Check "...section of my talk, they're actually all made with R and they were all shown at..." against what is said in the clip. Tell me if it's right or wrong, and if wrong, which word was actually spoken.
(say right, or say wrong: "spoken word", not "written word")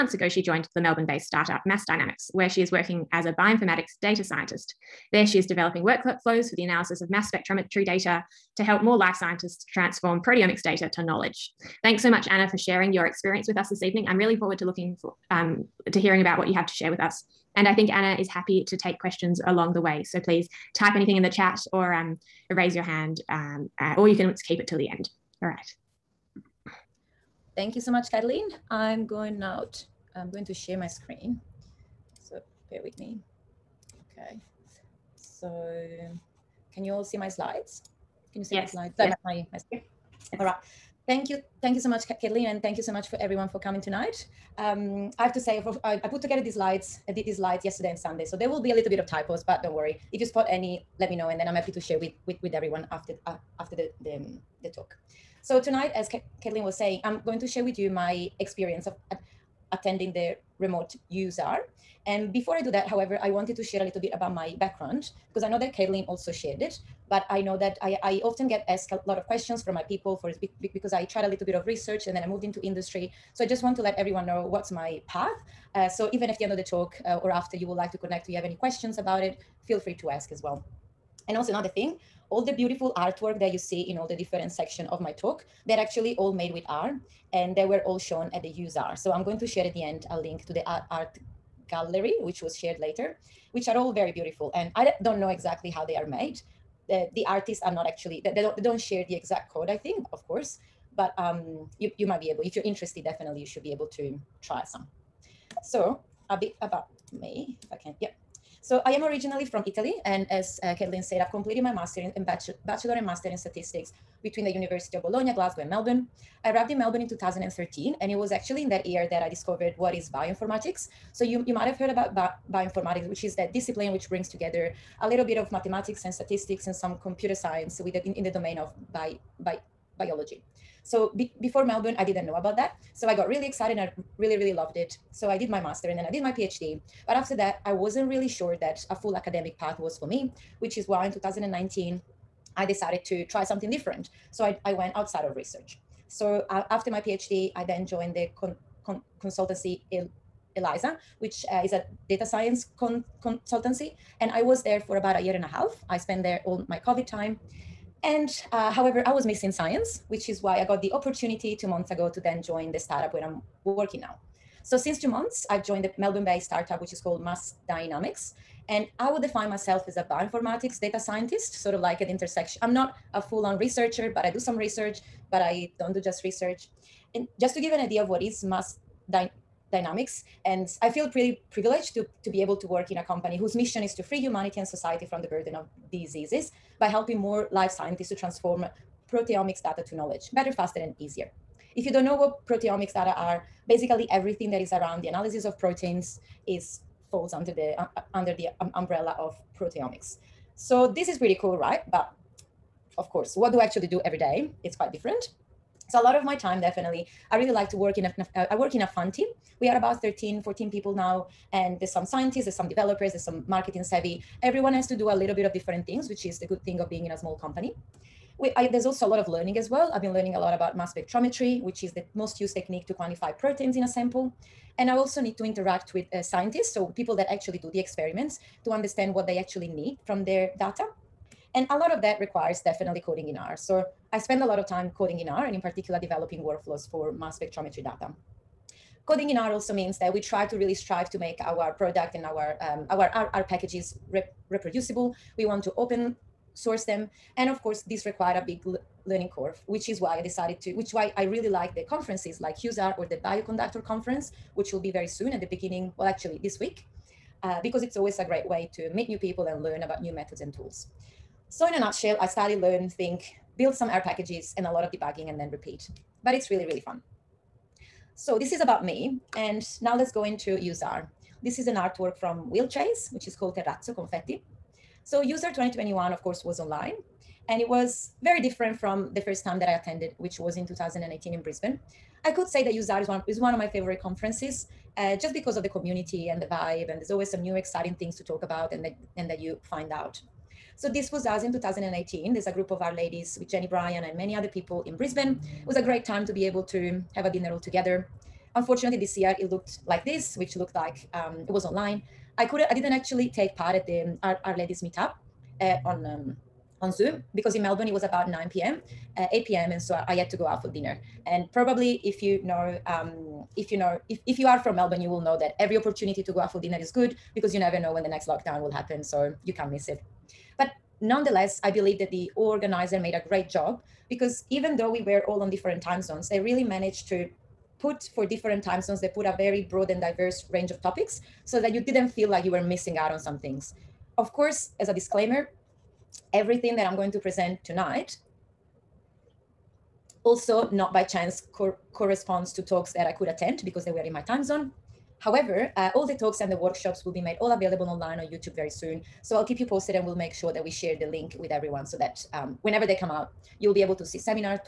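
right.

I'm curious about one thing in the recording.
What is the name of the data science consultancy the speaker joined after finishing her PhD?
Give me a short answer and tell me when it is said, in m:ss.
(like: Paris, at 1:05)
Eliiza, at 2:30.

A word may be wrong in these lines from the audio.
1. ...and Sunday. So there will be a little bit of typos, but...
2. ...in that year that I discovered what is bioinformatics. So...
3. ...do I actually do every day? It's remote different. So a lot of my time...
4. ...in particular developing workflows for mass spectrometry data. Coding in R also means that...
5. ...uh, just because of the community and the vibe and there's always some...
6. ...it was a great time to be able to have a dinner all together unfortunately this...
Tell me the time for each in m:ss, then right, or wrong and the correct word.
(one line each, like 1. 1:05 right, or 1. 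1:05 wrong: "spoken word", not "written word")
1. 0:47 right
2. 1:58 right
3. 3:23 wrong: "quite", not "remote"
4. 3:55 right
5. 4:44 right
6. 4:55 right.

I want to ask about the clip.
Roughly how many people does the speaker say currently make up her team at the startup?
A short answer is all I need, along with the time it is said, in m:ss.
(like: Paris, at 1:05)
13 or 14, at 3:30.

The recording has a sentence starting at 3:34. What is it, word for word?
Everyone has to do a little bit of different things, which is the good thing of being in a small company.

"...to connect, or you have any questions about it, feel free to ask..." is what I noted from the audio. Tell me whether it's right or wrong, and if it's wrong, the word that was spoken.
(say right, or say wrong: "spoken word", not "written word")
right.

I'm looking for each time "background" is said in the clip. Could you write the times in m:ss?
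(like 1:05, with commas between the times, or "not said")
1:04.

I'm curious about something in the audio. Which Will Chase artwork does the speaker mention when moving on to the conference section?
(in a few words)
Terrazzo Confetti.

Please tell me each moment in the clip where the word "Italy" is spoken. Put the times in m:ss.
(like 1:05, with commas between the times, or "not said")
1:49.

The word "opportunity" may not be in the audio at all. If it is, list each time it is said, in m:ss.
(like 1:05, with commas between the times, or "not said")
2:40, 5:15.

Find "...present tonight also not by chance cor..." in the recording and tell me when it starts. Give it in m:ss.
5:37.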